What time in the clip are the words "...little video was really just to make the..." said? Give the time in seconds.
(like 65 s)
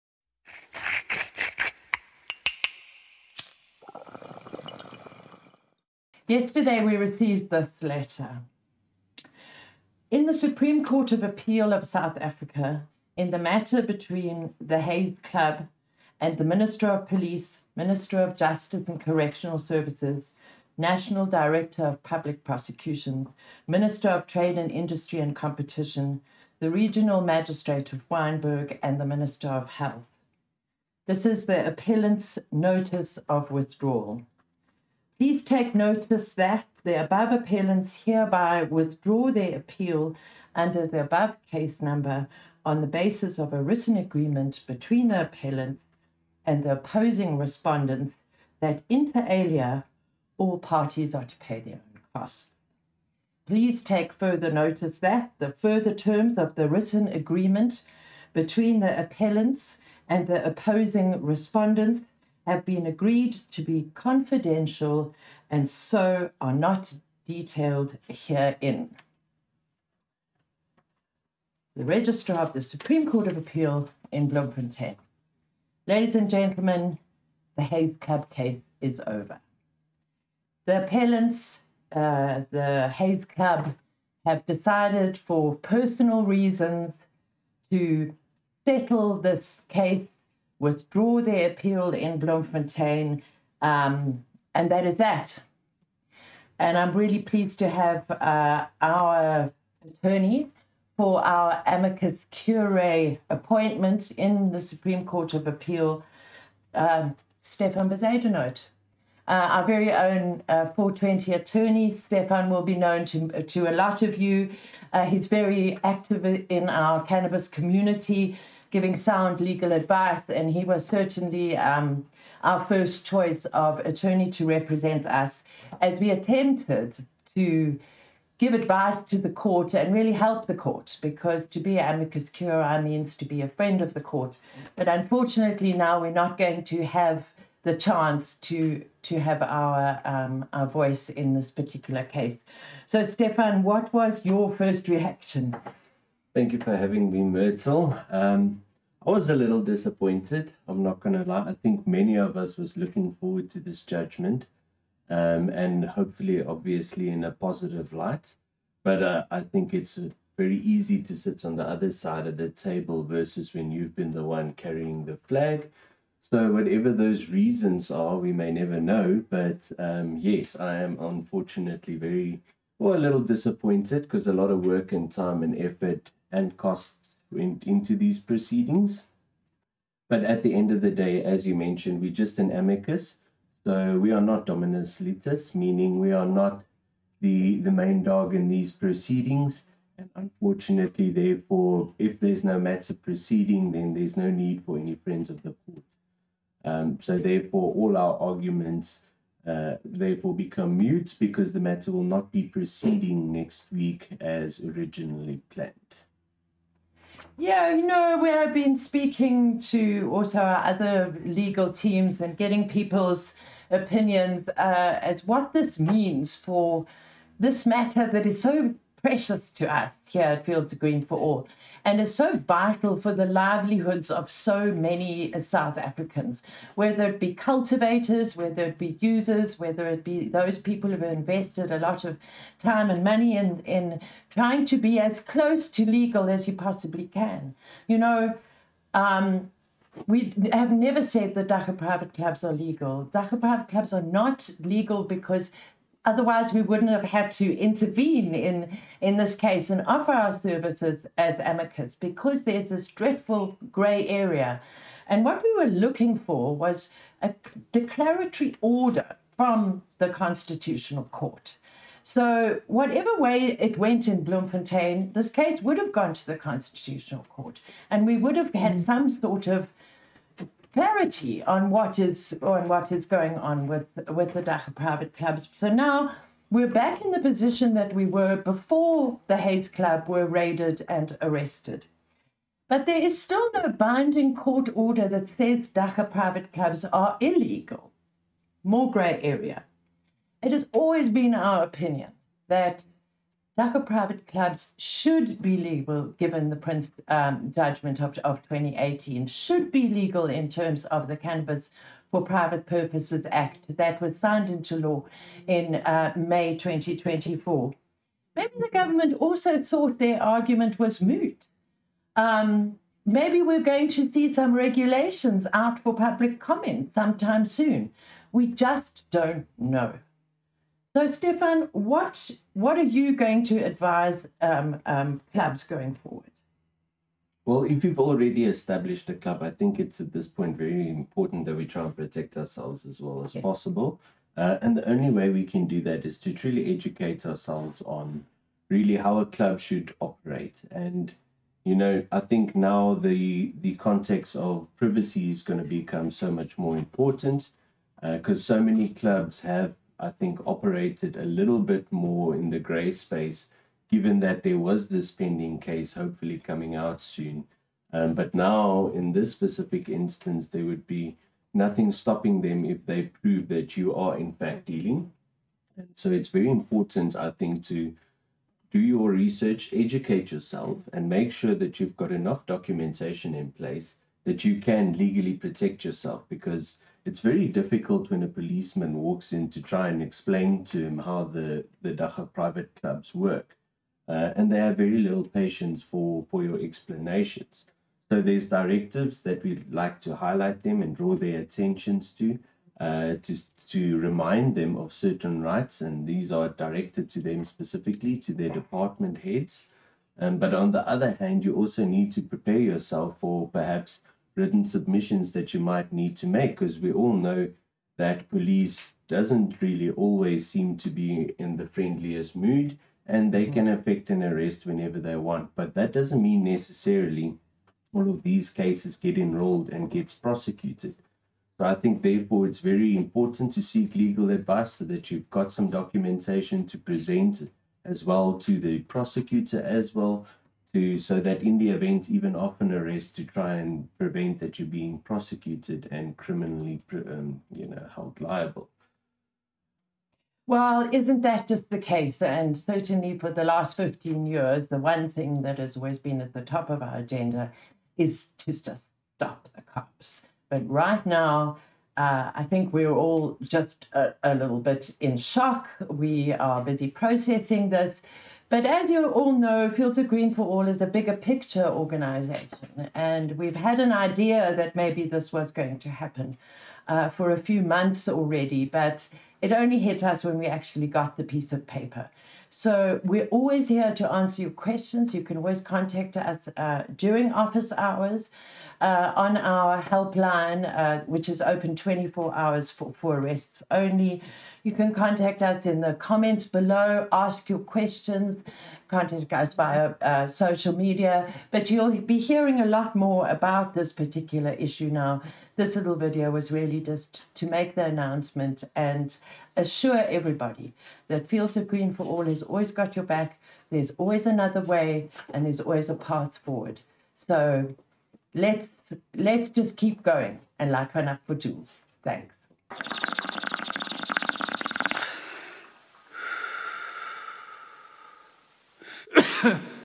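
495 s.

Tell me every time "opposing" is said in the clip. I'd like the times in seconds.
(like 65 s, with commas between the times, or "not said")
46 s, 60 s.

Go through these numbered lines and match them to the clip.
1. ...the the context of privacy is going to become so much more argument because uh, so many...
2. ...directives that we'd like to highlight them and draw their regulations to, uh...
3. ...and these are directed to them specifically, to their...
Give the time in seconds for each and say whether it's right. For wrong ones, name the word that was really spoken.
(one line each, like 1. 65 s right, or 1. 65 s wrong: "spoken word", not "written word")
1. 342 s wrong: "important", not "argument"
2. 388 s wrong: "attentions", not "regulations"
3. 395 s right.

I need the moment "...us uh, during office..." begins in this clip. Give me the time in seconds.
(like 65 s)
476 s.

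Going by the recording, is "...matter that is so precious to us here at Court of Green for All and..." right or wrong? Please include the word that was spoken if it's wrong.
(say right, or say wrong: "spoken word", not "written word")
wrong: "Fields", not "Court".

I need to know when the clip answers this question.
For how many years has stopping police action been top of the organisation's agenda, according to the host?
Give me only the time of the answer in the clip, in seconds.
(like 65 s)
443 s.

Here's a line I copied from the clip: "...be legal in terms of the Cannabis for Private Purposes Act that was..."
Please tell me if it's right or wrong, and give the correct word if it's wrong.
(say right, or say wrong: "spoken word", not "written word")
right.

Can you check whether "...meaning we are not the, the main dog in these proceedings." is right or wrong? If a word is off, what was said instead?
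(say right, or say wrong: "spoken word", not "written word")
right.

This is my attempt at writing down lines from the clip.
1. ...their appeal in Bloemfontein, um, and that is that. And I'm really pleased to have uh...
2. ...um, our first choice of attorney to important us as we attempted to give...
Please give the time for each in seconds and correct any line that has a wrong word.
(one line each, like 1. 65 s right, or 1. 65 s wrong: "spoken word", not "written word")
1. 91 s right
2. 121 s wrong: "represent", not "important".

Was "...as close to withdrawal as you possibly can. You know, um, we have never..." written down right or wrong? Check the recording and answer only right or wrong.
wrong.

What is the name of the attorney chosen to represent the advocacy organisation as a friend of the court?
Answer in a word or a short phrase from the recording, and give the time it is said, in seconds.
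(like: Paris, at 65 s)
Stefan Bezuidenhout, at 107 s.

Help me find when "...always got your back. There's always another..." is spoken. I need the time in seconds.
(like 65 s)
502 s.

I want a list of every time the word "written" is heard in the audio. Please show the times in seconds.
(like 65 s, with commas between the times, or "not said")
43 s, 56 s, 404 s.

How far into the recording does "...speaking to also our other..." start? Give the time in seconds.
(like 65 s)
208 s.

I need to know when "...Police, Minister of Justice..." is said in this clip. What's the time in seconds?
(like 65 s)
17 s.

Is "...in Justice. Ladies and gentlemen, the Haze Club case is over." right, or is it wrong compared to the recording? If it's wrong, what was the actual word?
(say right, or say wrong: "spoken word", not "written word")
wrong: "Bloemfontein", not "Justice".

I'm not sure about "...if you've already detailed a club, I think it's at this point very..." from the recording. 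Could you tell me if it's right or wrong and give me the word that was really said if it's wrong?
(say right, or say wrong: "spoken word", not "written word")
wrong: "established", not "detailed".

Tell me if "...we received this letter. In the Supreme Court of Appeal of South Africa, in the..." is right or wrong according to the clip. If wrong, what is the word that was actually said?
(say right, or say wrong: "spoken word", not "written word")
right.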